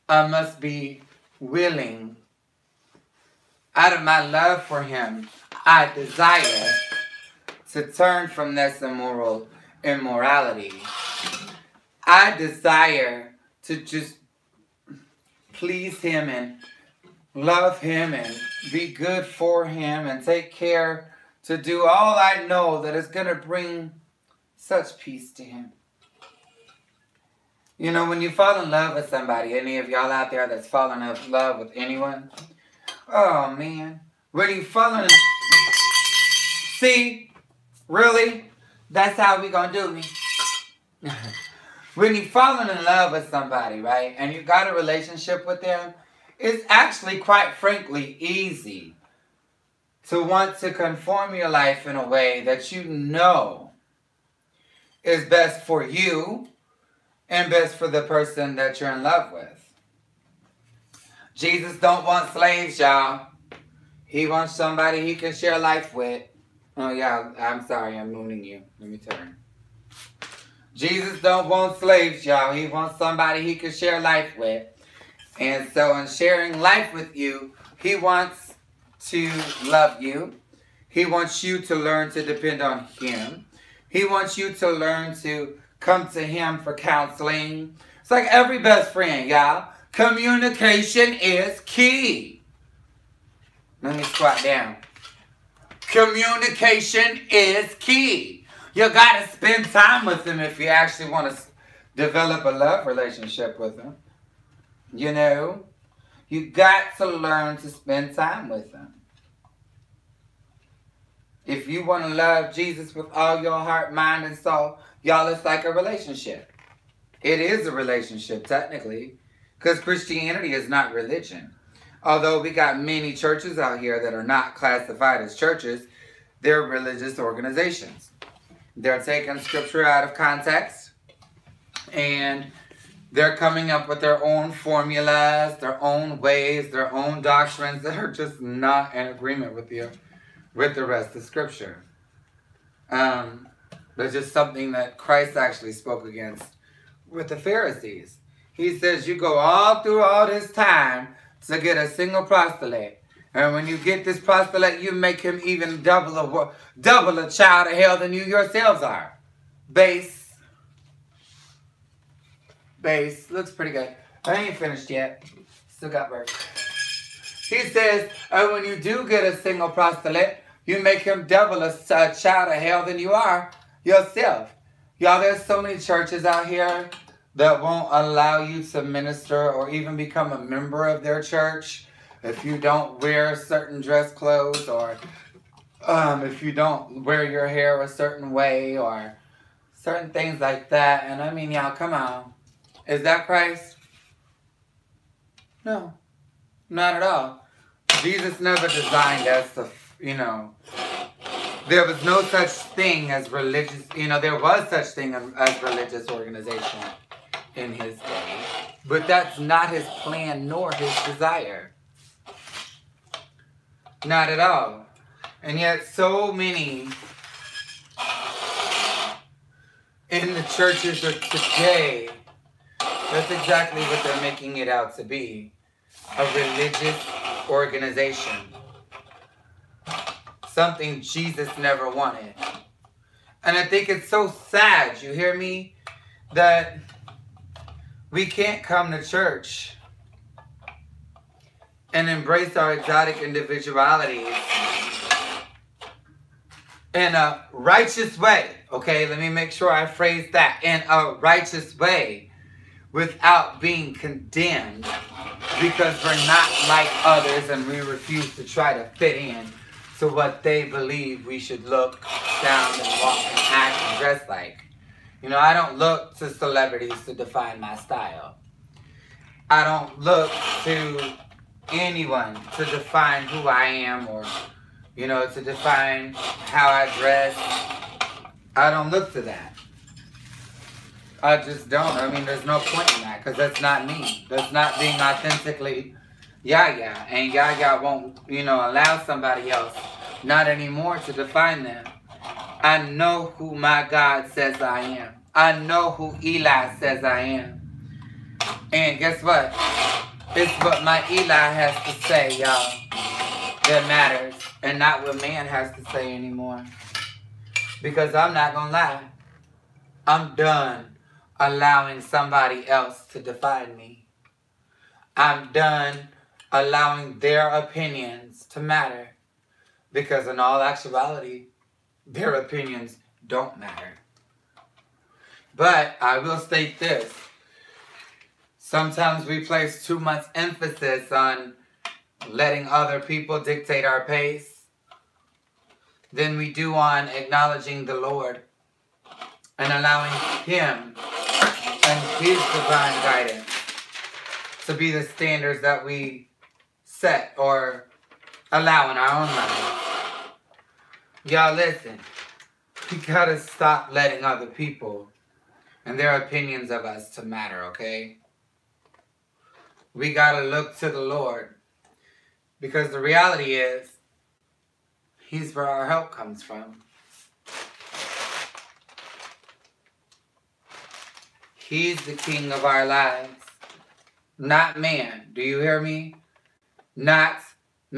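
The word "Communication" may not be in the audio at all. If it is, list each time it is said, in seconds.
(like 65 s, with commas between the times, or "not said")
89 s, 95 s.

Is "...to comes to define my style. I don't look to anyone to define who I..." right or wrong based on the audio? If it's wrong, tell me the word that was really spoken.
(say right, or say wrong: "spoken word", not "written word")
wrong: "celebrities", not "comes".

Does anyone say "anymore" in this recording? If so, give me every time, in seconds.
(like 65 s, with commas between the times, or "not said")
290 s, 306 s.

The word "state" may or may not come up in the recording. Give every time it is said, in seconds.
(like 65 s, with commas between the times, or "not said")
326 s.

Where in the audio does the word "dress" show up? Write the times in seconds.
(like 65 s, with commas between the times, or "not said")
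183 s, 263 s, 276 s.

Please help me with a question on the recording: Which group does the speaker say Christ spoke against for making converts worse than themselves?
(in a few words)
The Pharisees.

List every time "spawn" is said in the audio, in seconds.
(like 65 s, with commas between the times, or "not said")
not said.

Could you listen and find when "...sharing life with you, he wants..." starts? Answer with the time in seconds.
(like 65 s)
76 s.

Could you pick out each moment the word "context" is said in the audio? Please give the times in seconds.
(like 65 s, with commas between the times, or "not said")
130 s.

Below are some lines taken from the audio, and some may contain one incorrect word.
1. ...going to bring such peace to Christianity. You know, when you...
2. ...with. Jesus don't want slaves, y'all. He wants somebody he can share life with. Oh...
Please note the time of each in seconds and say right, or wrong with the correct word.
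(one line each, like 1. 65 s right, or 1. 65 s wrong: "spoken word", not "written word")
1. 23 s wrong: "Him", not "Christianity"
2. 59 s right.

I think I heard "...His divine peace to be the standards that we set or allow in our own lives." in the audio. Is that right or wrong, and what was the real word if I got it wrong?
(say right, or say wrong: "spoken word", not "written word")
wrong: "guidance", not "peace".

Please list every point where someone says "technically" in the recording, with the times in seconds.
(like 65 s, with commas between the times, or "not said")
118 s.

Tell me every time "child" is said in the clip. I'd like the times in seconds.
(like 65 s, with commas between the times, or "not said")
157 s, 172 s.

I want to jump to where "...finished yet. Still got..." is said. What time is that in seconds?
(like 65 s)
164 s.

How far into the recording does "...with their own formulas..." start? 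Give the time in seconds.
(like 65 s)
133 s.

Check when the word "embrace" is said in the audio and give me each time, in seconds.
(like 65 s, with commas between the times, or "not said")
242 s.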